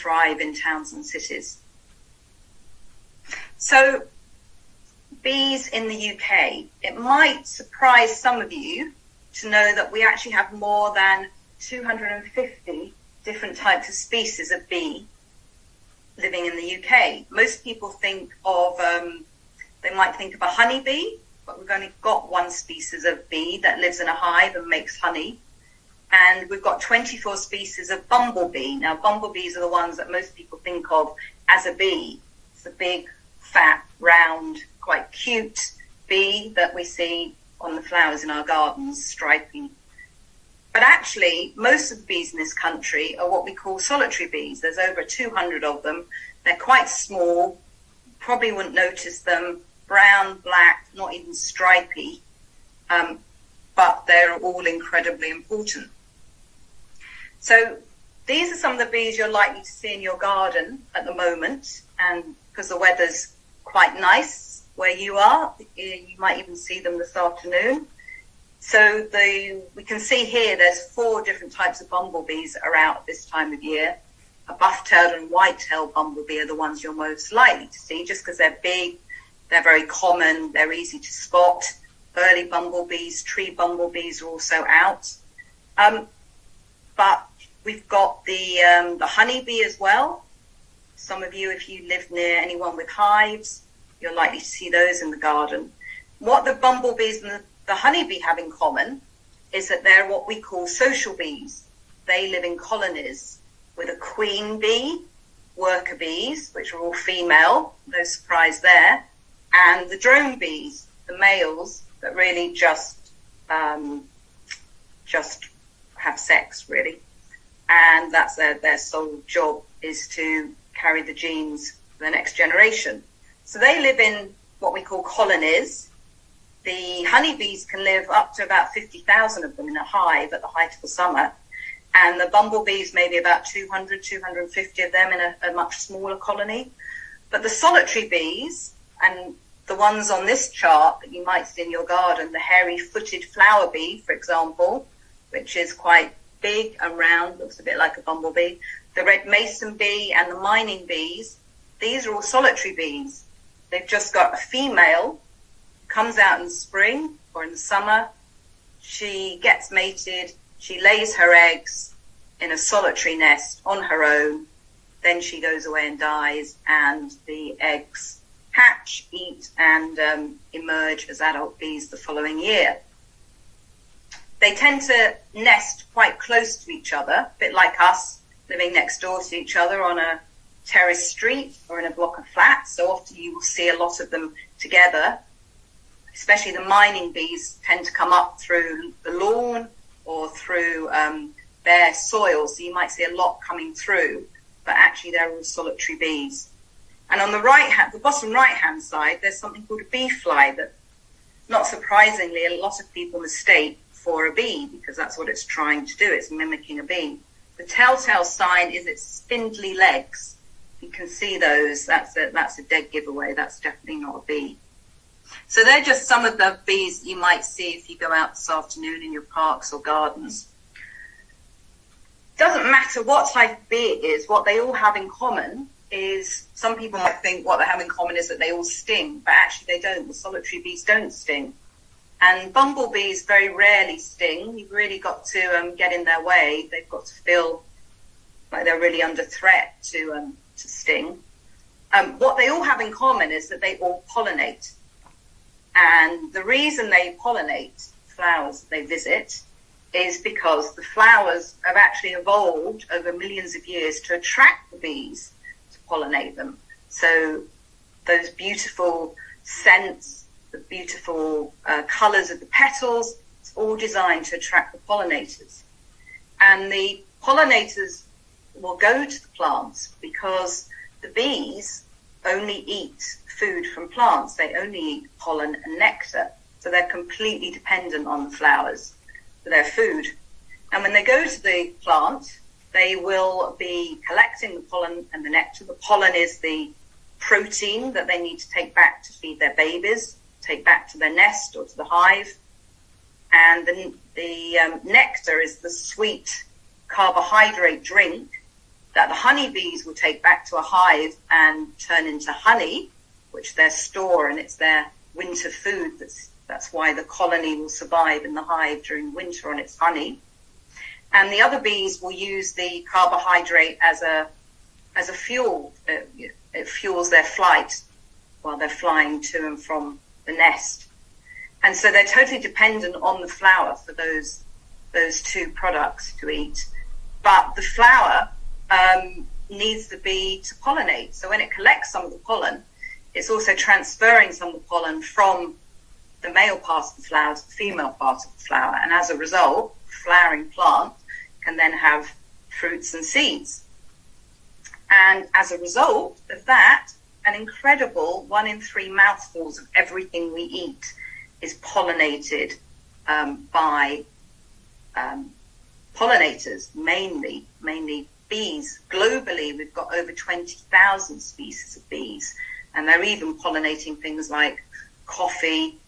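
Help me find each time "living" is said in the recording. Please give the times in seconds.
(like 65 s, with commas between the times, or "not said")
16 s, 178 s.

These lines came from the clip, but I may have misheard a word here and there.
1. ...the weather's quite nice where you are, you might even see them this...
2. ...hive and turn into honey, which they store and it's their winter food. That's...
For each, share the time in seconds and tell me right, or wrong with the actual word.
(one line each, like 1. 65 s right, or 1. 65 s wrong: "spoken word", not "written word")
1. 62 s right
2. 300 s right.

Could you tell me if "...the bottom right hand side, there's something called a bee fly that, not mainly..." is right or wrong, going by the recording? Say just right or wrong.
wrong.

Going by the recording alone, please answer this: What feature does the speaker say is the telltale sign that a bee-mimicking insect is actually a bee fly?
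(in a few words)
Spindly legs.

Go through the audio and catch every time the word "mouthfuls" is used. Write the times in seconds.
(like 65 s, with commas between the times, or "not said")
348 s.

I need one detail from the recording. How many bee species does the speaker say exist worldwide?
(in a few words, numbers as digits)
Over 20,000.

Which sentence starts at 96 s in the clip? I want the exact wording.
What the bumblebees and the, the honeybee have in common is that they're what we call social bees.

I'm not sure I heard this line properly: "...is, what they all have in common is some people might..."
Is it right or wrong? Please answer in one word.
right.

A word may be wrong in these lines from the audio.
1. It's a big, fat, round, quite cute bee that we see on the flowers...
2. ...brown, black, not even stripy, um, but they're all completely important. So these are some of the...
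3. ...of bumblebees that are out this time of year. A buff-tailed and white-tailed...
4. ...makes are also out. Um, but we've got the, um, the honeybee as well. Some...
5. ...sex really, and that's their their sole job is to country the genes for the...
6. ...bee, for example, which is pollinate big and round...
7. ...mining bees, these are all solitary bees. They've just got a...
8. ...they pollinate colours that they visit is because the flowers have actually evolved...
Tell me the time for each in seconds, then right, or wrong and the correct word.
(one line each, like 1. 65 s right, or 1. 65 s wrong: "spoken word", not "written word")
1. 32 s right
2. 49 s wrong: "incredibly", not "completely"
3. 71 s right
4. 83 s wrong: "bumblebees", not "makes"
5. 116 s wrong: "carry", not "country"
6. 143 s wrong: "quite", not "pollinate"
7. 150 s right
8. 246 s wrong: "flowers", not "colours".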